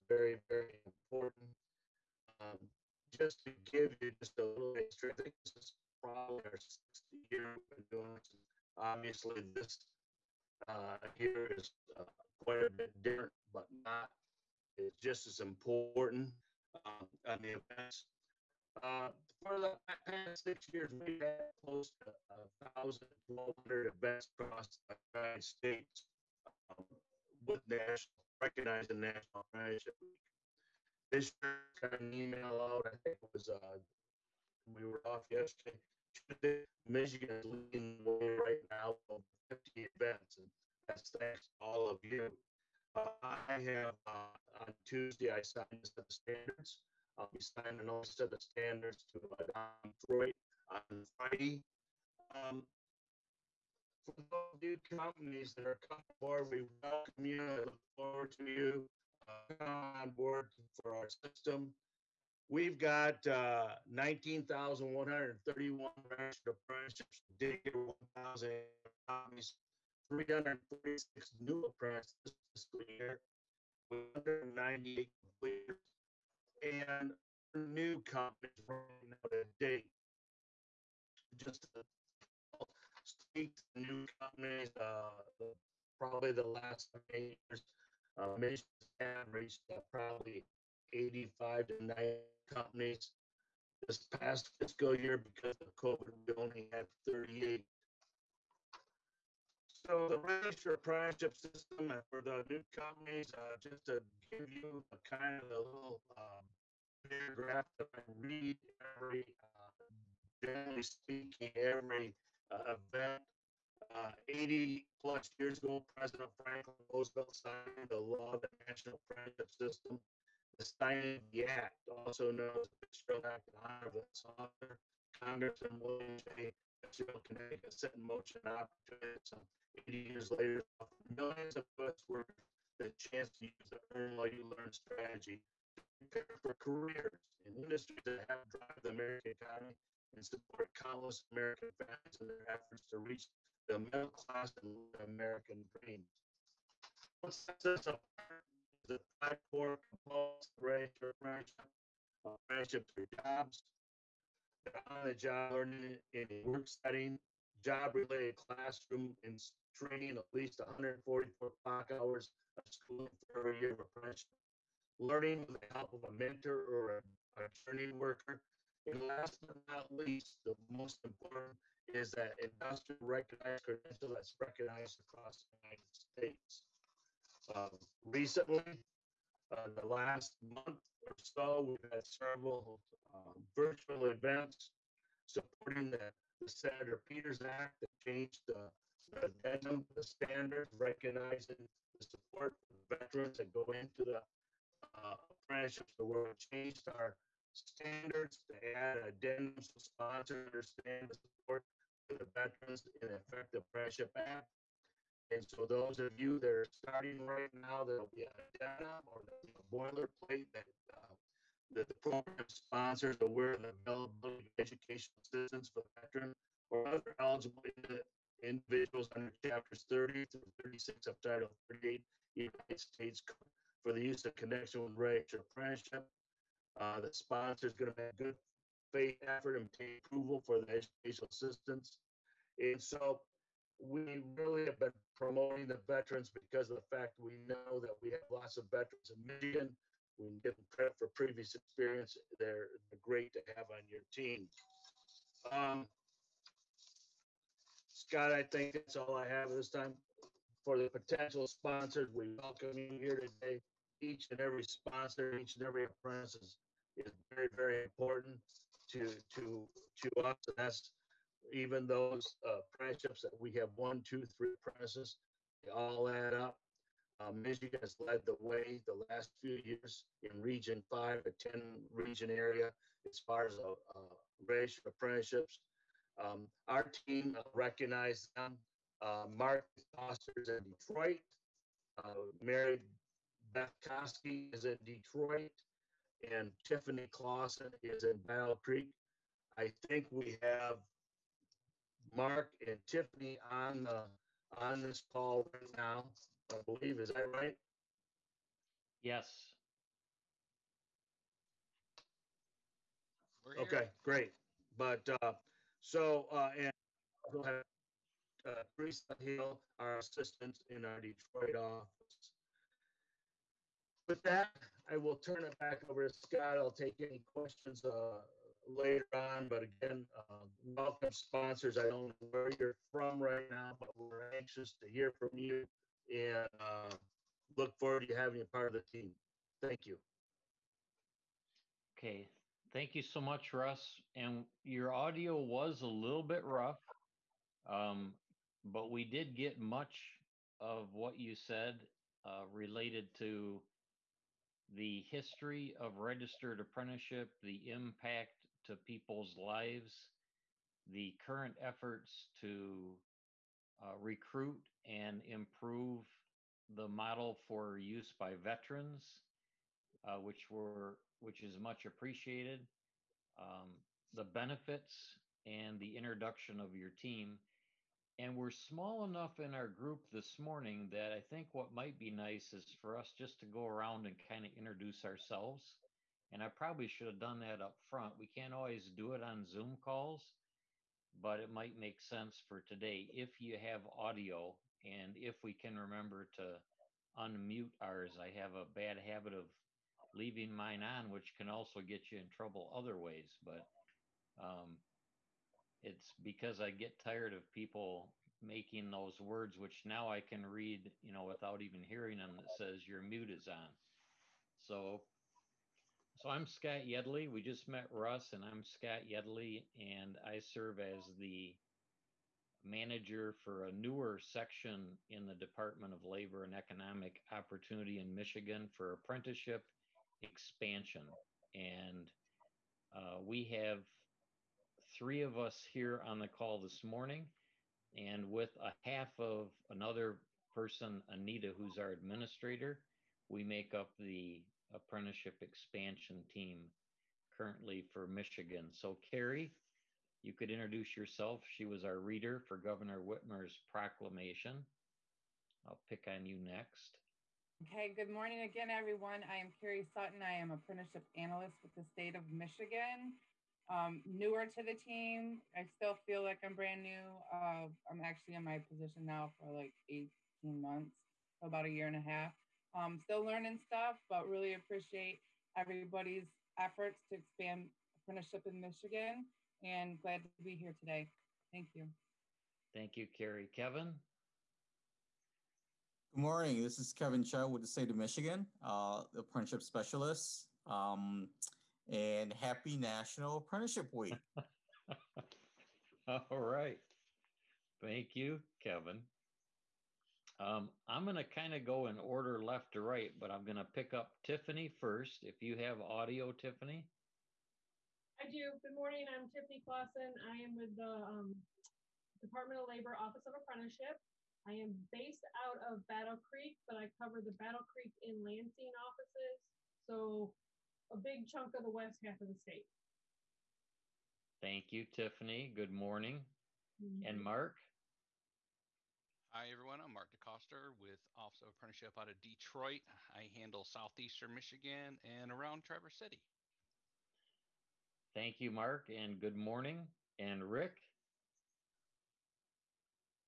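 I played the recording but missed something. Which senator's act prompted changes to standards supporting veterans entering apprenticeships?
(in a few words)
Senator Peters.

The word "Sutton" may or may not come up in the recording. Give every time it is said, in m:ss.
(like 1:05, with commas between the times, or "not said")
7:29.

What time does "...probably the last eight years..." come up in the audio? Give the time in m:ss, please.
1:25.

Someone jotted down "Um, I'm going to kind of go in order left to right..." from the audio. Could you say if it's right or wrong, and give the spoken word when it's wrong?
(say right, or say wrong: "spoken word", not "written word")
right.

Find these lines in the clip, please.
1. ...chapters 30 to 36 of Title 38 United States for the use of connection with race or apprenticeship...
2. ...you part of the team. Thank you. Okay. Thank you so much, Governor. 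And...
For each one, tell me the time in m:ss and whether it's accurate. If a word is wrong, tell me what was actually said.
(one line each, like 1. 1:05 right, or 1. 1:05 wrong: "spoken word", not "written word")
1. 3:39 right
2. 5:28 wrong: "Russ", not "Governor".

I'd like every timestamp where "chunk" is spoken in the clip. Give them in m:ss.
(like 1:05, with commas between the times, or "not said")
8:31.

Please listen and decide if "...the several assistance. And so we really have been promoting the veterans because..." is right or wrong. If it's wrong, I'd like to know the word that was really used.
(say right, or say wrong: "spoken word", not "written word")
wrong: "educational", not "several".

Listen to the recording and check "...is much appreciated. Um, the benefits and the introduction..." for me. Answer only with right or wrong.
right.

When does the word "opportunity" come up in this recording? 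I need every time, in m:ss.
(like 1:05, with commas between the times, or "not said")
2:08, 6:57.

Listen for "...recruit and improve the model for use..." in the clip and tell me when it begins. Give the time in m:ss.
5:53.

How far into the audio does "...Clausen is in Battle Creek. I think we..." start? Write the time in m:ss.
4:47.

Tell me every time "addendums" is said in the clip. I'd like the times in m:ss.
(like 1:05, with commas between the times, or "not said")
3:19, 3:28.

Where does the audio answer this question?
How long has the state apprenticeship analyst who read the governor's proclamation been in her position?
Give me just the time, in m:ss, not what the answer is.
7:39.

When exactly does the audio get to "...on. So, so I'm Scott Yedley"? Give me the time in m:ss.
6:43.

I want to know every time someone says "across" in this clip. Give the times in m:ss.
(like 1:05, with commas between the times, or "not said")
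0:24, 2:54.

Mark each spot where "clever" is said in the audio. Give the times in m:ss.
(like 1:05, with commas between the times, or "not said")
not said.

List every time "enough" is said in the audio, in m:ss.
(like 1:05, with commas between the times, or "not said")
6:09.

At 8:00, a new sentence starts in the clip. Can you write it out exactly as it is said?
Um, and happy National Apprenticeship Week.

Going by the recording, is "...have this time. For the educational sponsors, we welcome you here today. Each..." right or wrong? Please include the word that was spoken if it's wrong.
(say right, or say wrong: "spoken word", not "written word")
wrong: "potential", not "educational".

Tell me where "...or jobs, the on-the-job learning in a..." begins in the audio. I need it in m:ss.
2:32.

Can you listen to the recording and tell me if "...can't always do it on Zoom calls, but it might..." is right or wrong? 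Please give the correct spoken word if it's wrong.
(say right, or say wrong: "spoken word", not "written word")
right.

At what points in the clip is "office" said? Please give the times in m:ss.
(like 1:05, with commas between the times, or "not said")
5:11, 8:22, 8:28, 8:41.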